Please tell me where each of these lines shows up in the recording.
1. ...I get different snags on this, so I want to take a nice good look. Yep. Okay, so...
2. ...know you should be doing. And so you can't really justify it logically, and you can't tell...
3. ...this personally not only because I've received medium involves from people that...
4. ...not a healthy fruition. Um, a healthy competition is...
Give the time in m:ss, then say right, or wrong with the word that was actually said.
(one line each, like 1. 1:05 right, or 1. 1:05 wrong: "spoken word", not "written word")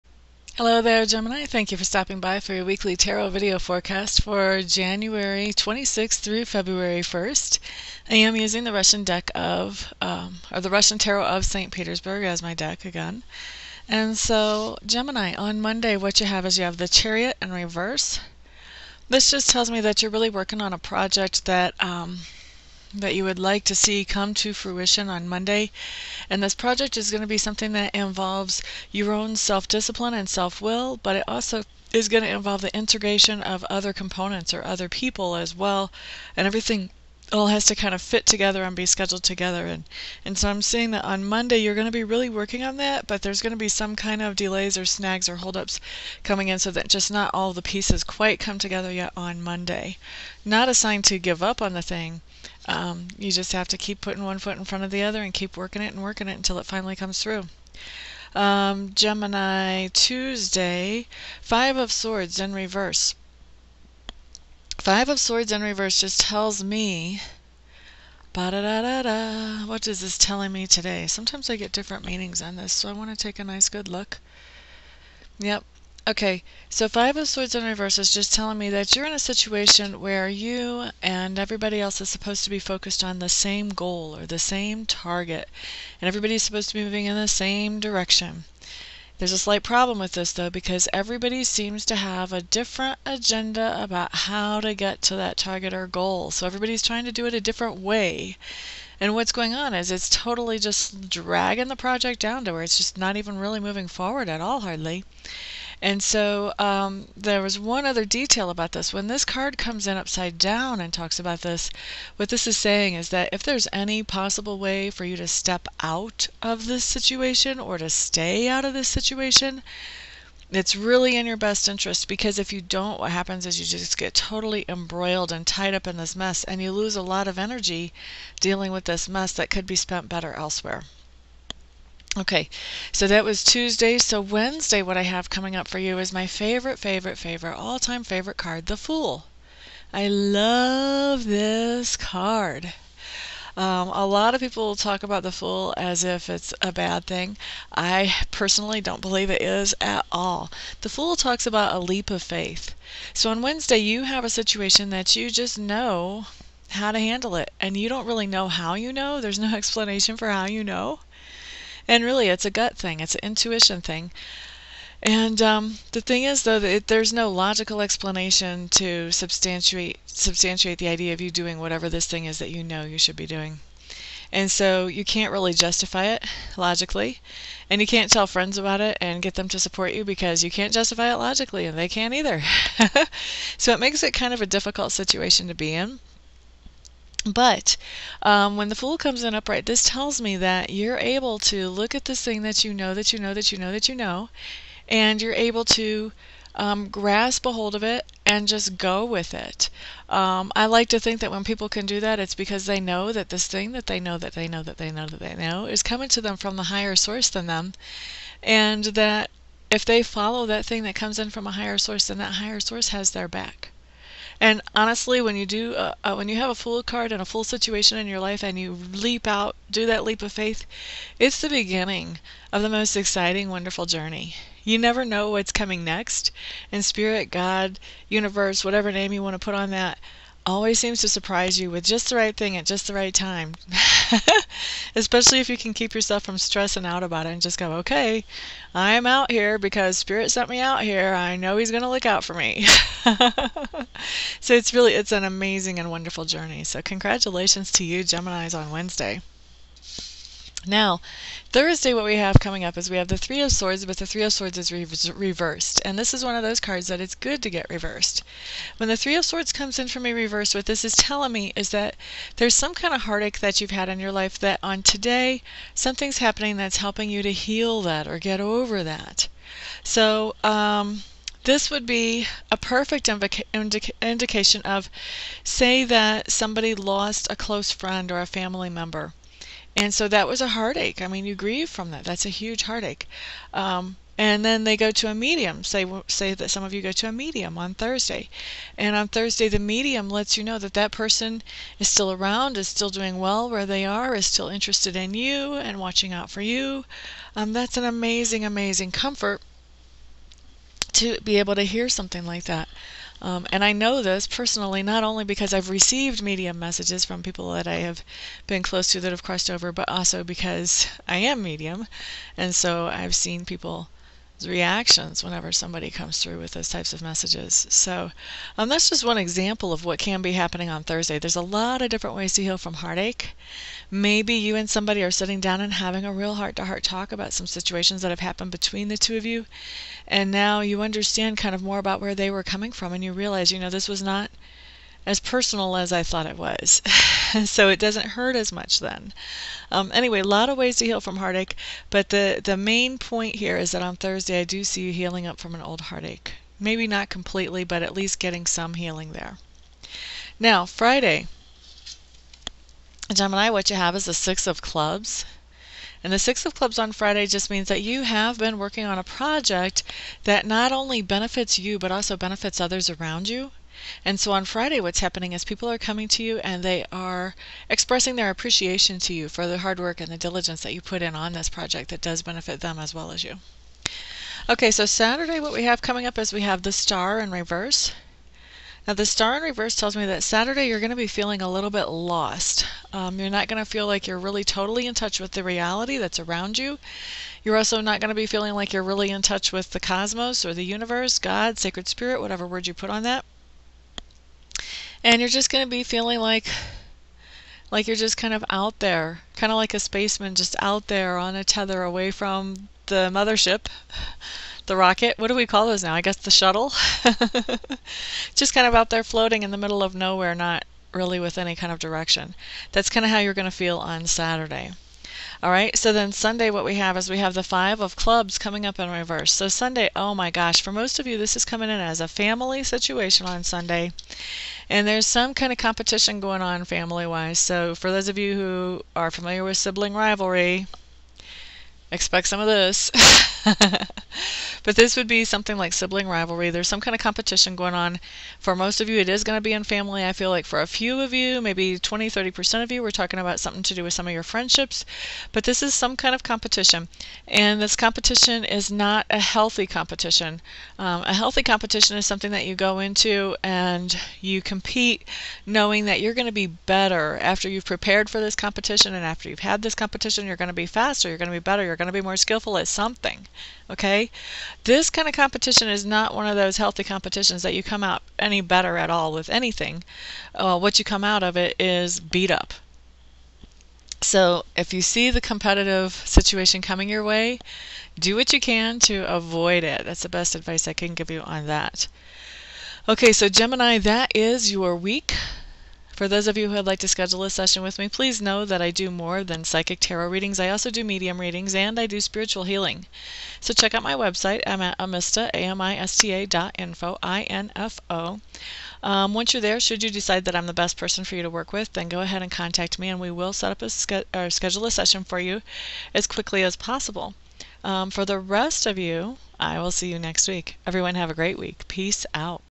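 1. 1:11 wrong: "meanings", not "snags"
2. 2:52 right
3. 5:04 wrong: "messages", not "involves"
4. 7:28 wrong: "competition", not "fruition".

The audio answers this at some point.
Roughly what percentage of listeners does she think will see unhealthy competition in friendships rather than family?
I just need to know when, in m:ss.
7:21.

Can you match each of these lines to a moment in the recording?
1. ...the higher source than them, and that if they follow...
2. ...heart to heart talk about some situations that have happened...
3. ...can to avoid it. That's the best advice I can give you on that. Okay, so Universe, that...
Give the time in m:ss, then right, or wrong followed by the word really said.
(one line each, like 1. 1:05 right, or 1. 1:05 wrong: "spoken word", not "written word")
1. 3:26 right
2. 5:26 right
3. 7:58 wrong: "Gemini", not "Universe".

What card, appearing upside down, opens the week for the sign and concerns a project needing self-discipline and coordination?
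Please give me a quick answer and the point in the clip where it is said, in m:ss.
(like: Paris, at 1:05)
The Chariot, at 0:16.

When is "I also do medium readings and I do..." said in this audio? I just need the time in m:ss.
8:10.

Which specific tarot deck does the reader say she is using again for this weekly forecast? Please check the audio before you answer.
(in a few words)
Russian tarot of St. Petersburg.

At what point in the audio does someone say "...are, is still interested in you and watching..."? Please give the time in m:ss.
4:53.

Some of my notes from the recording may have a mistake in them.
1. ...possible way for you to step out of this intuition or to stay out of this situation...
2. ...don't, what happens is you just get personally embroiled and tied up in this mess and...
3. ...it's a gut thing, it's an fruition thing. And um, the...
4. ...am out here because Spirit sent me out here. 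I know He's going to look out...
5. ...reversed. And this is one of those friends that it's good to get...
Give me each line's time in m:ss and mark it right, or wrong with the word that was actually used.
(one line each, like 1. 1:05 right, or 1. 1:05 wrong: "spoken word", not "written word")
1. 1:54 wrong: "situation", not "intuition"
2. 2:02 wrong: "totally", not "personally"
3. 2:42 wrong: "intuition", not "fruition"
4. 3:58 right
5. 4:15 wrong: "cards", not "friends".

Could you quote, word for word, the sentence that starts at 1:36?
So everybody's trying to do it a different way.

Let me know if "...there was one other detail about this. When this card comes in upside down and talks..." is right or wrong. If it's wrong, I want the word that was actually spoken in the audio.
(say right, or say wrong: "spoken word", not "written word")
right.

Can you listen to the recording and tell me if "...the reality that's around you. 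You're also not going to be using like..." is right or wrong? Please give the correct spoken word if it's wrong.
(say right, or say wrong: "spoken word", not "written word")
wrong: "feeling", not "using".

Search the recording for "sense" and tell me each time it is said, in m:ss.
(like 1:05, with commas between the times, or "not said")
not said.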